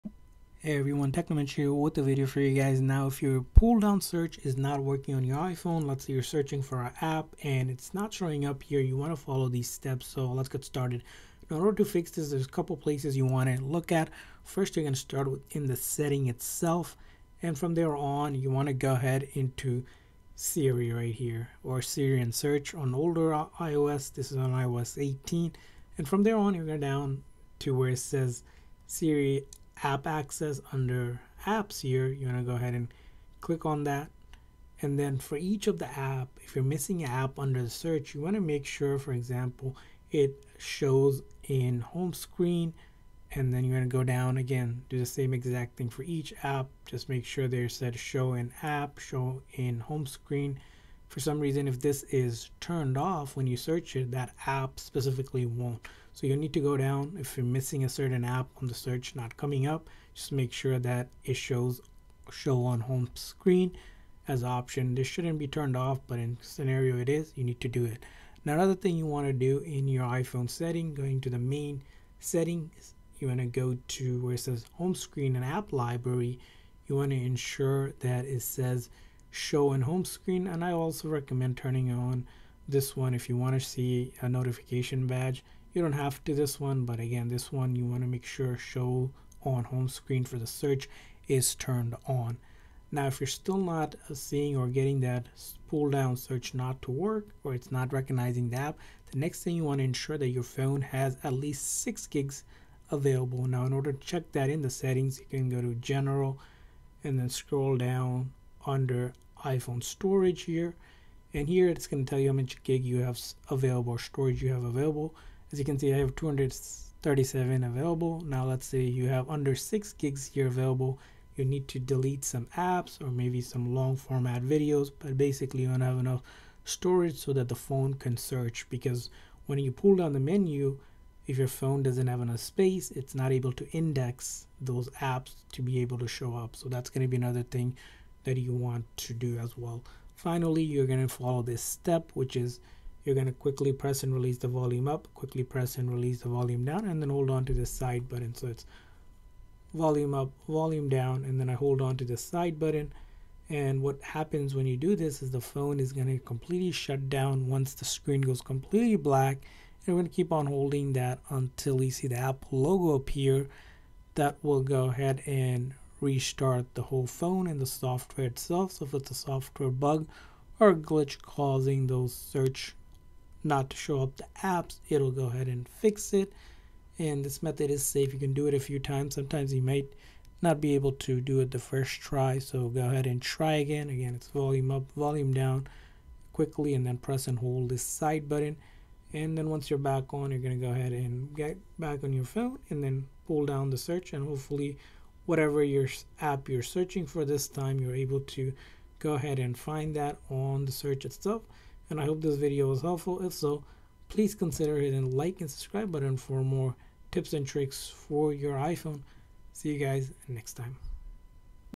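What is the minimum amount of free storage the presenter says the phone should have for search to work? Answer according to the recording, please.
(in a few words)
6 gigs.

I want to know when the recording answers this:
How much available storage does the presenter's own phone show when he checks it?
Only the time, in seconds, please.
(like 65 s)
116 s.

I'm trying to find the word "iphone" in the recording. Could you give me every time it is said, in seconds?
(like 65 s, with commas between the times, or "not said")
5 s, 70 s, 109 s, 208 s.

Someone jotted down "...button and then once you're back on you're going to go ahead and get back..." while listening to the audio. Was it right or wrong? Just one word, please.
right.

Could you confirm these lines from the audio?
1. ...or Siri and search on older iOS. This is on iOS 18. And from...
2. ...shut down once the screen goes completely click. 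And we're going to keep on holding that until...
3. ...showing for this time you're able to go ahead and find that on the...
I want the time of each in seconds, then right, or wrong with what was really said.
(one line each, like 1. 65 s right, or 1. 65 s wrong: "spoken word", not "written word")
1. 21 s right
2. 156 s wrong: "black", not "click"
3. 196 s wrong: "searching", not "showing".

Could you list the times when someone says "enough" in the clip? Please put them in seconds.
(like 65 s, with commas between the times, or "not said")
125 s, 132 s.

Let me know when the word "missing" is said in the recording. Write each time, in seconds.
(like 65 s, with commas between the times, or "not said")
36 s, 57 s.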